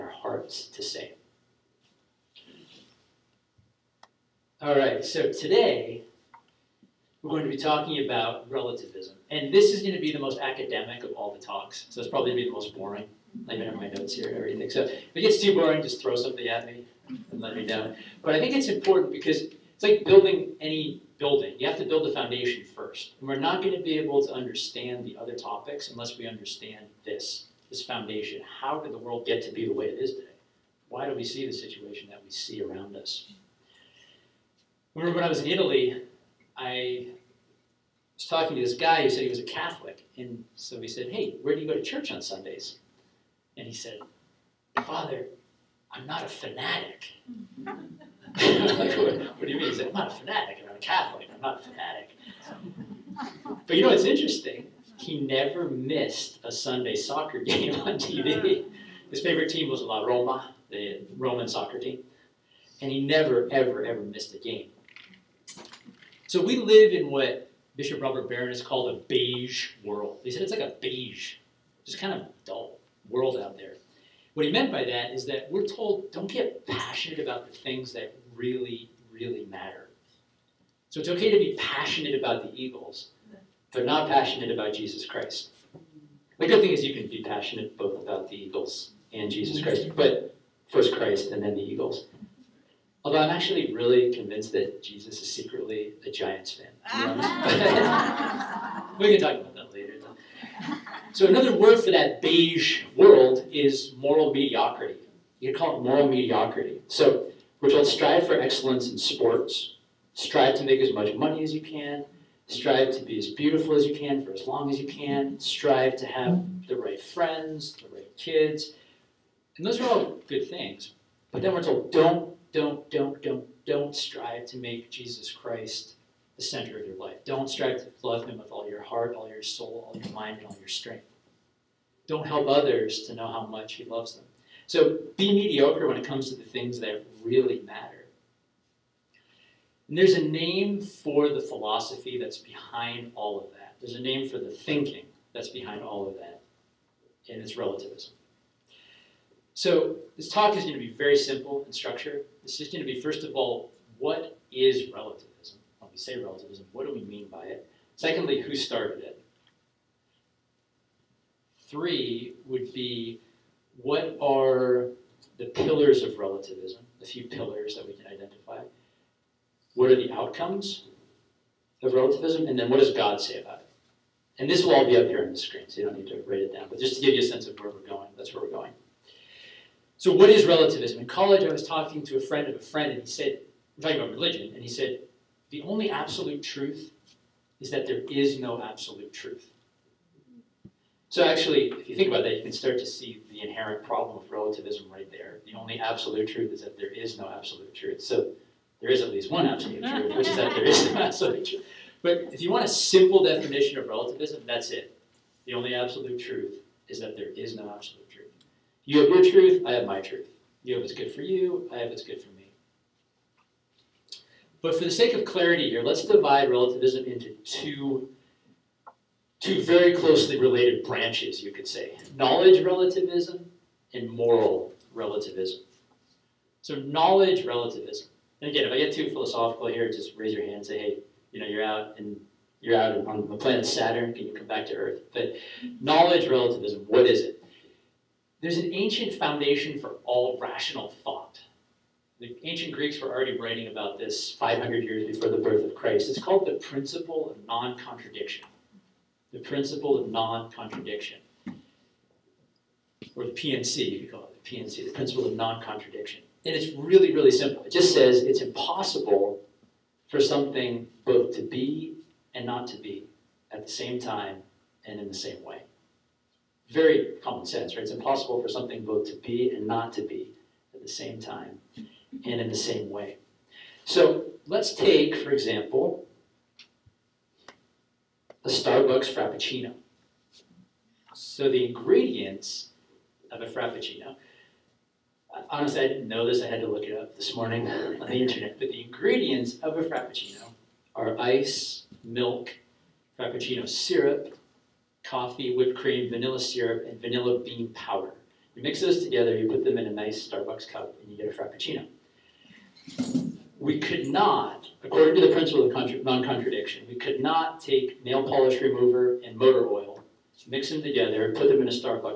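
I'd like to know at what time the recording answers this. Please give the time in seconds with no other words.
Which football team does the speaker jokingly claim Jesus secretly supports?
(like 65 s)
96 s.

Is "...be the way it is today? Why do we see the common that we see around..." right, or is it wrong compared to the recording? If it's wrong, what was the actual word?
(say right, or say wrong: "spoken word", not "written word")
wrong: "situation", not "common".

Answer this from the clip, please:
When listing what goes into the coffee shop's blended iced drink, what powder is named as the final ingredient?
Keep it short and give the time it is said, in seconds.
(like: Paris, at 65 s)
vanilla bean powder, at 296 s.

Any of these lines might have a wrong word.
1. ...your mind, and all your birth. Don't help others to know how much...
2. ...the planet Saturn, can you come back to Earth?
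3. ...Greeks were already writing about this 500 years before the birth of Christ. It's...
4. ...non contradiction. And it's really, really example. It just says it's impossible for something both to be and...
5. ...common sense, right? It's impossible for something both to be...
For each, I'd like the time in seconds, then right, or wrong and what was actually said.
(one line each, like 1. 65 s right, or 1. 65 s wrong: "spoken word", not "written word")
1. 129 s wrong: "strength", not "birth"
2. 233 s right
3. 242 s right
4. 255 s wrong: "simple", not "example"
5. 267 s right.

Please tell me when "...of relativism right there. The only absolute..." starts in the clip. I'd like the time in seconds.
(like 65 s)
194 s.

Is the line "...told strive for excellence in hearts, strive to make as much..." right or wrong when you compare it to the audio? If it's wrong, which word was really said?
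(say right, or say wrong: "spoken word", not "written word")
wrong: "sports", not "hearts".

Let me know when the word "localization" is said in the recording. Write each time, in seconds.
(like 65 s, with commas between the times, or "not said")
not said.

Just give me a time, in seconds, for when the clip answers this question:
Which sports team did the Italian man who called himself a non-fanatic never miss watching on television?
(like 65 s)
59 s.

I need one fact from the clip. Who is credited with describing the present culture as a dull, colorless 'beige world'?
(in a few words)
Bishop Robert Barron.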